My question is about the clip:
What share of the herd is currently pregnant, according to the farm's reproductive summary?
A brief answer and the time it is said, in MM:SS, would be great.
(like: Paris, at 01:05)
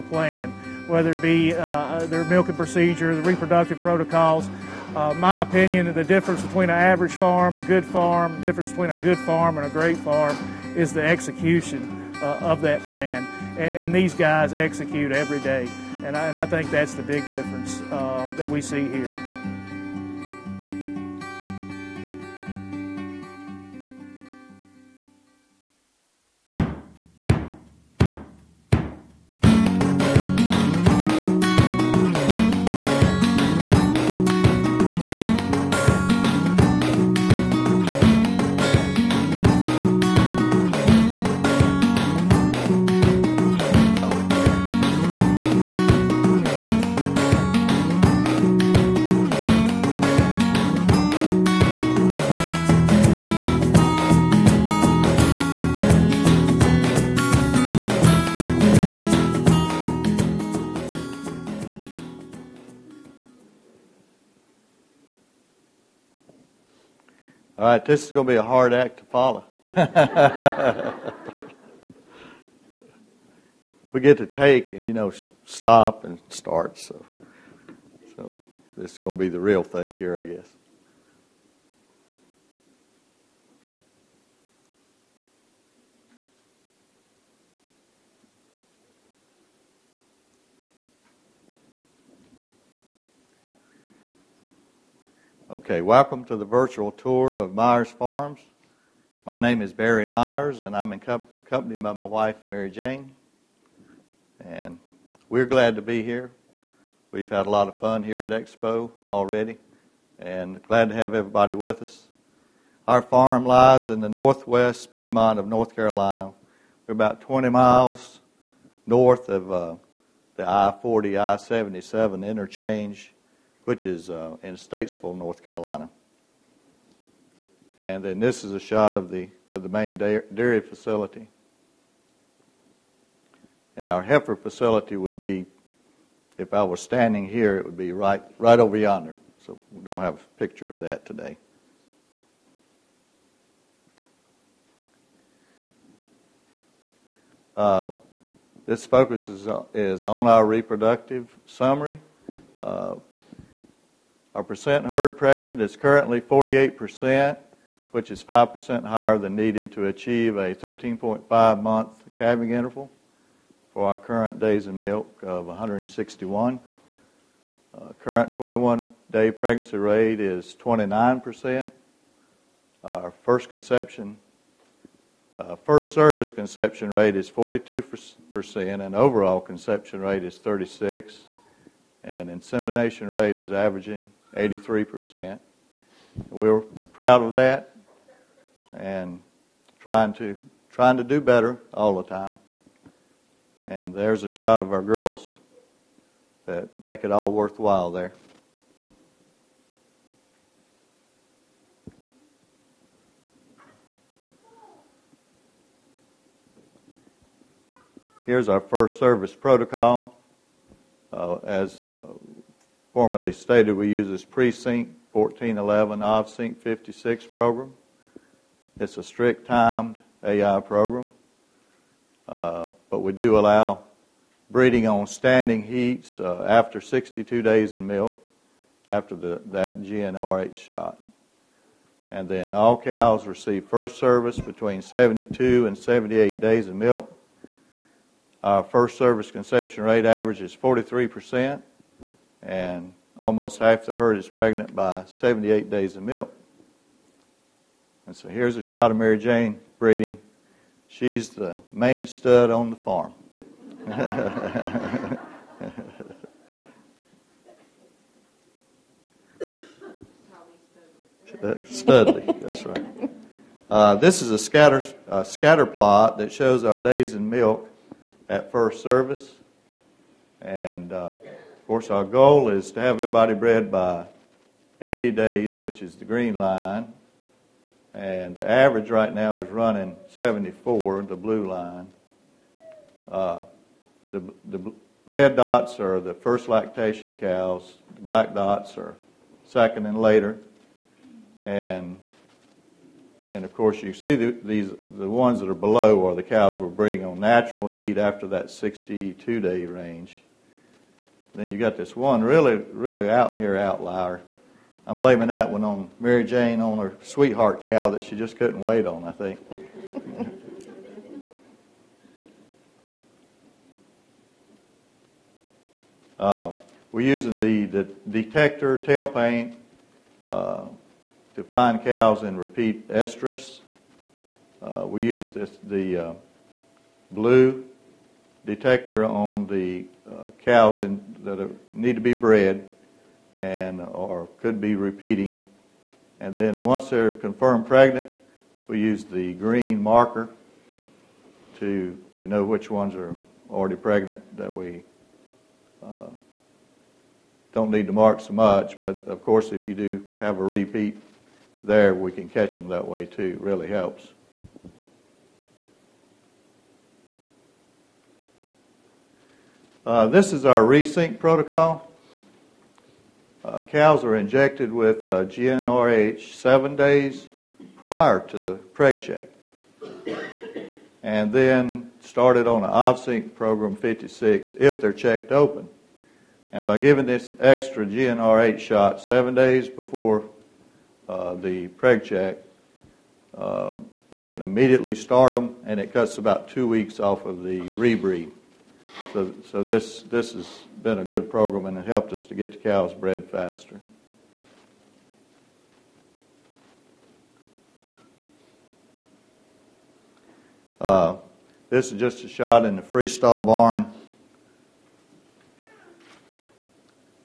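48%, at 02:36.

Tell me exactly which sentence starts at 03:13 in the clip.
And there's a shot of our girls that make it all worthwhile there.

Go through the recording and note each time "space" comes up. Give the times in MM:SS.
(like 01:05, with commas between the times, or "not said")
not said.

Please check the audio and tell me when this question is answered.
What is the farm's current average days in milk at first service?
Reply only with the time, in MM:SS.
04:40.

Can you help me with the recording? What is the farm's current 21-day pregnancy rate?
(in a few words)
29%.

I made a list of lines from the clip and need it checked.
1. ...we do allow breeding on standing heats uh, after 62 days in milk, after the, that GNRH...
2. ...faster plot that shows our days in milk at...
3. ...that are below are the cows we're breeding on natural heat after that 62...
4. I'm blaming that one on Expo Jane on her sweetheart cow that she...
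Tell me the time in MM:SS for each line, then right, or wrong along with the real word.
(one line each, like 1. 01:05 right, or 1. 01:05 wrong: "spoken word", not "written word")
1. 03:42 right
2. 04:25 wrong: "scatter", not "faster"
3. 04:55 right
4. 05:04 wrong: "Mary", not "Expo".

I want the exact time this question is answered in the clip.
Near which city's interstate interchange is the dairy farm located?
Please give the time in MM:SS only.
02:04.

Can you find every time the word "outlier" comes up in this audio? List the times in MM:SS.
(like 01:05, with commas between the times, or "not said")
05:03.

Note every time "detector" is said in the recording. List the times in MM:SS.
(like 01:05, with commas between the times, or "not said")
05:18, 05:28.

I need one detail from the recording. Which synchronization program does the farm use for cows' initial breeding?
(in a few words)
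Presynch 1411 OVSYNC 56.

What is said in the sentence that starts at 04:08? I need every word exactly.
And so here's a shot of Mary Jane breeding.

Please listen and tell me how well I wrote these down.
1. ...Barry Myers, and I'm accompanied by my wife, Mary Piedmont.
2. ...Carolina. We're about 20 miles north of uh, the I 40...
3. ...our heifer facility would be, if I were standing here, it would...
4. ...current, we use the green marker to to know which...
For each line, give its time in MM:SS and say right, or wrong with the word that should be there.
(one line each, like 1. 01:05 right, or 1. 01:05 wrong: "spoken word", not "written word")
1. 01:39 wrong: "Jane", not "Piedmont"
2. 01:55 right
3. 02:13 right
4. 05:37 wrong: "pregnant", not "current".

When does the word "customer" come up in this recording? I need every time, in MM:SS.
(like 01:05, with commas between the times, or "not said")
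not said.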